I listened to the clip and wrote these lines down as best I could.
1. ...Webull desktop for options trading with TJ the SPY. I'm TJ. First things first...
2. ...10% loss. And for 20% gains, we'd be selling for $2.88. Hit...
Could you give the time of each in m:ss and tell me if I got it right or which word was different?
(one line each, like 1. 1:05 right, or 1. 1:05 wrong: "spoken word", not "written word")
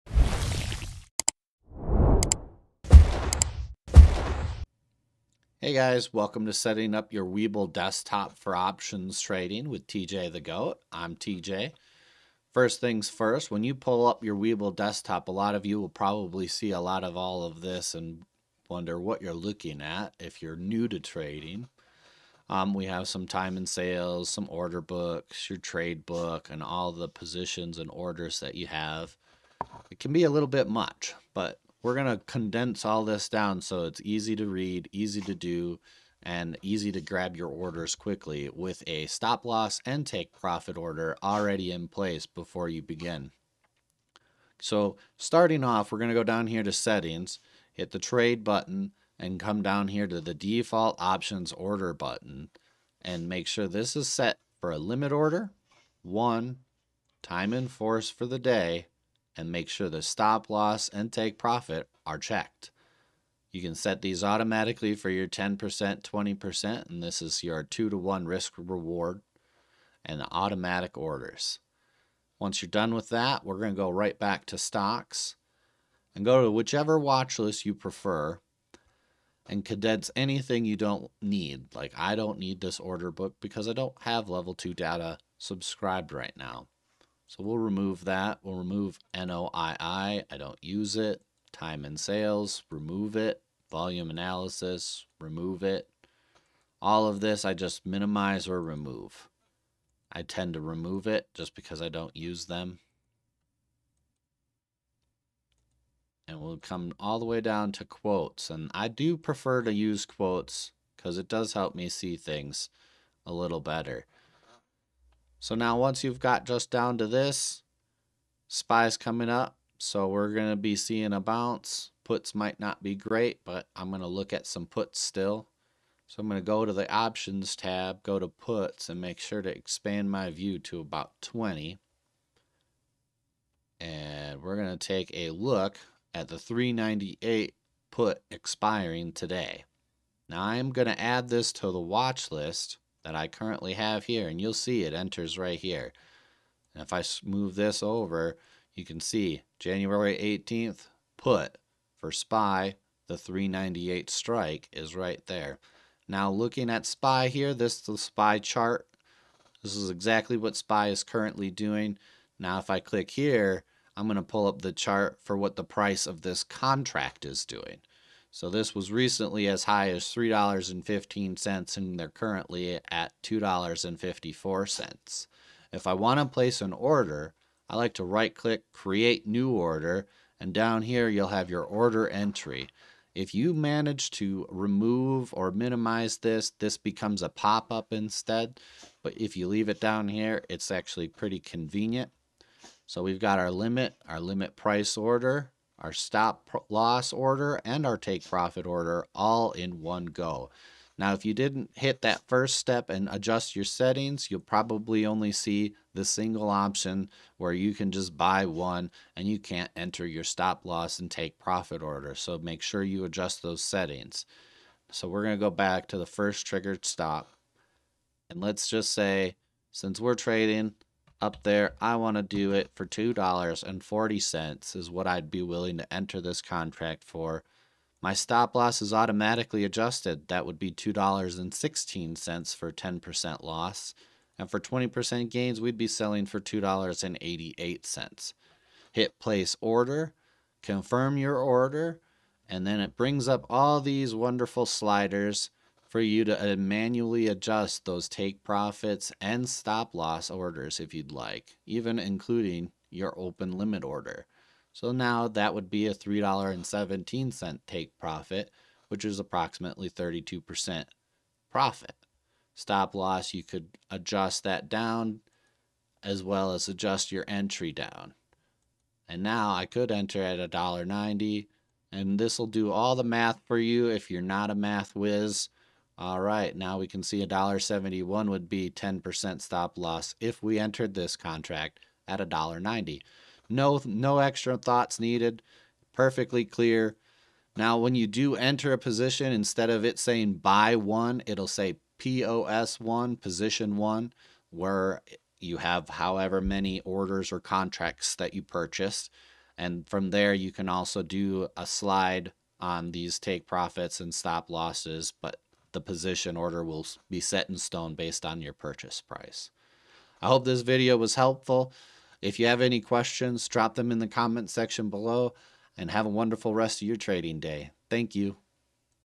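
1. 0:07 wrong: "Goat", not "SPY"
2. 3:52 right.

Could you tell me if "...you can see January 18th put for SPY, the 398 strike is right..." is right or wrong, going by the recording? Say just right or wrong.
right.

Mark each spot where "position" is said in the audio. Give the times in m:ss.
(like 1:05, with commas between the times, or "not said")
0:27, 4:48, 4:53, 5:05.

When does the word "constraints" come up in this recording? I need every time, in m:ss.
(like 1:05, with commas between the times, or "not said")
not said.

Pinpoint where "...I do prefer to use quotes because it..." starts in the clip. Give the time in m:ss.
1:48.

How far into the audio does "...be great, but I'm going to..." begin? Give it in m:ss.
2:02.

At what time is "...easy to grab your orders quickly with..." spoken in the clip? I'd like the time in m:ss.
0:36.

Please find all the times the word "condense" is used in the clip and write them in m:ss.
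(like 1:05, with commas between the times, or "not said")
0:32, 1:19.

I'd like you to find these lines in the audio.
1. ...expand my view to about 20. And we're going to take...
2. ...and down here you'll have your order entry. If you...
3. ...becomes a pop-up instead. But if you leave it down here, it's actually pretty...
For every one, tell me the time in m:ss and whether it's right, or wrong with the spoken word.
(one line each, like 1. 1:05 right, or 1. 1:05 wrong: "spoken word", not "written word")
1. 2:09 right
2. 3:00 right
3. 3:06 right.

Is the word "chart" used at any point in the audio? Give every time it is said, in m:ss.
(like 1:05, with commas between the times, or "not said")
2:38, 2:44.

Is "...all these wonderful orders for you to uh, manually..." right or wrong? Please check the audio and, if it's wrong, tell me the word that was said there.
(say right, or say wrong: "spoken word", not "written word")
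wrong: "sliders", not "orders".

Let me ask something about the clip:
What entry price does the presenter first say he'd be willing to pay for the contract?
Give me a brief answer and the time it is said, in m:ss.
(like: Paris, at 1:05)
$2.40, at 3:42.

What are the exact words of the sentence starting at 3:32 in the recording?
So make sure you adjust those settings.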